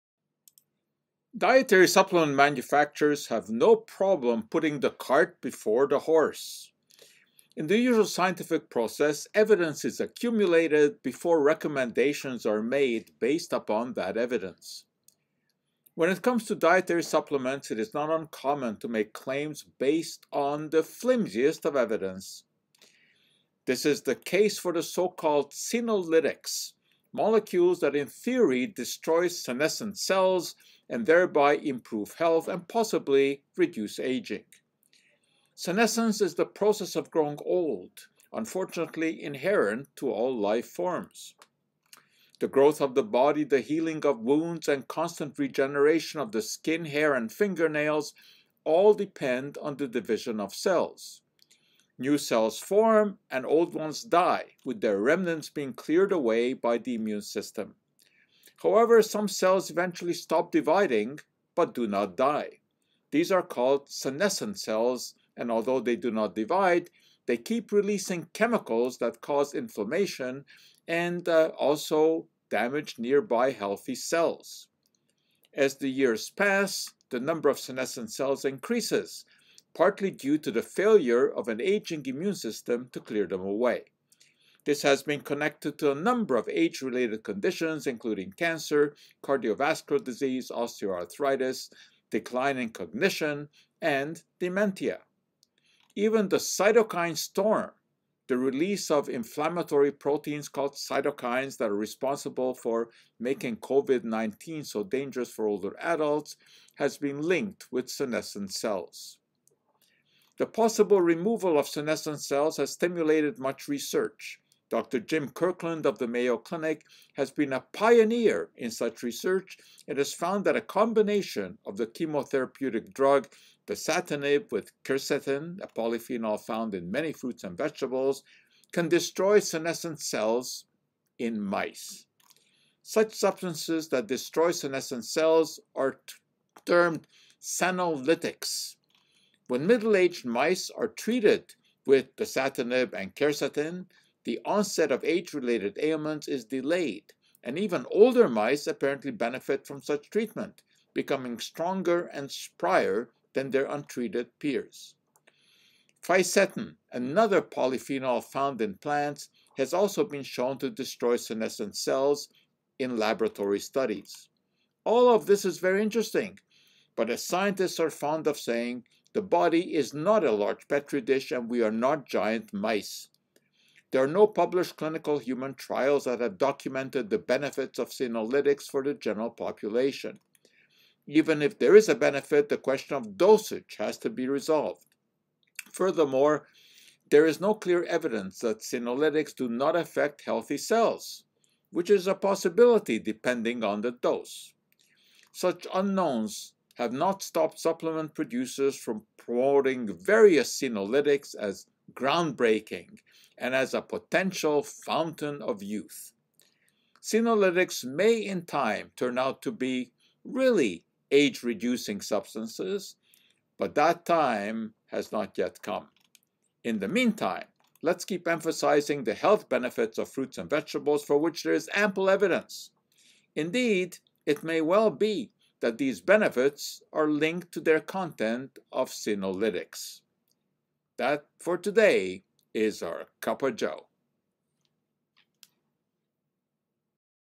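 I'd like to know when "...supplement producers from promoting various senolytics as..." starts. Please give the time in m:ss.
3:17.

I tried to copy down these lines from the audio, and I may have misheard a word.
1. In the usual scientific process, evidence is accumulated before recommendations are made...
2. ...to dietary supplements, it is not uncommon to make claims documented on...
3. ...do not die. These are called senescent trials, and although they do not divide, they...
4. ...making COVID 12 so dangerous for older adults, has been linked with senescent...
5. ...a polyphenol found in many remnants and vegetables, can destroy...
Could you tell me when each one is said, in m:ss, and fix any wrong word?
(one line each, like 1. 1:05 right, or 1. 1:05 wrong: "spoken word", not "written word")
1. 0:07 right
2. 0:16 wrong: "based", not "documented"
3. 1:01 wrong: "cells", not "trials"
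4. 1:43 wrong: "19", not "12"
5. 2:05 wrong: "fruits", not "remnants".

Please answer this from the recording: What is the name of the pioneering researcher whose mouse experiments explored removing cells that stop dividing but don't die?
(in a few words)
Jim Kirkland.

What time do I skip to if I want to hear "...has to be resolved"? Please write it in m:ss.
3:03.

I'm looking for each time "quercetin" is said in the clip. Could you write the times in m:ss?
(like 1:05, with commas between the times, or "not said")
2:04, 2:23.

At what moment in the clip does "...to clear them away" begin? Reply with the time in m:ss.
1:22.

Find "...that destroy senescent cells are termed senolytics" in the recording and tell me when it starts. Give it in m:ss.
2:13.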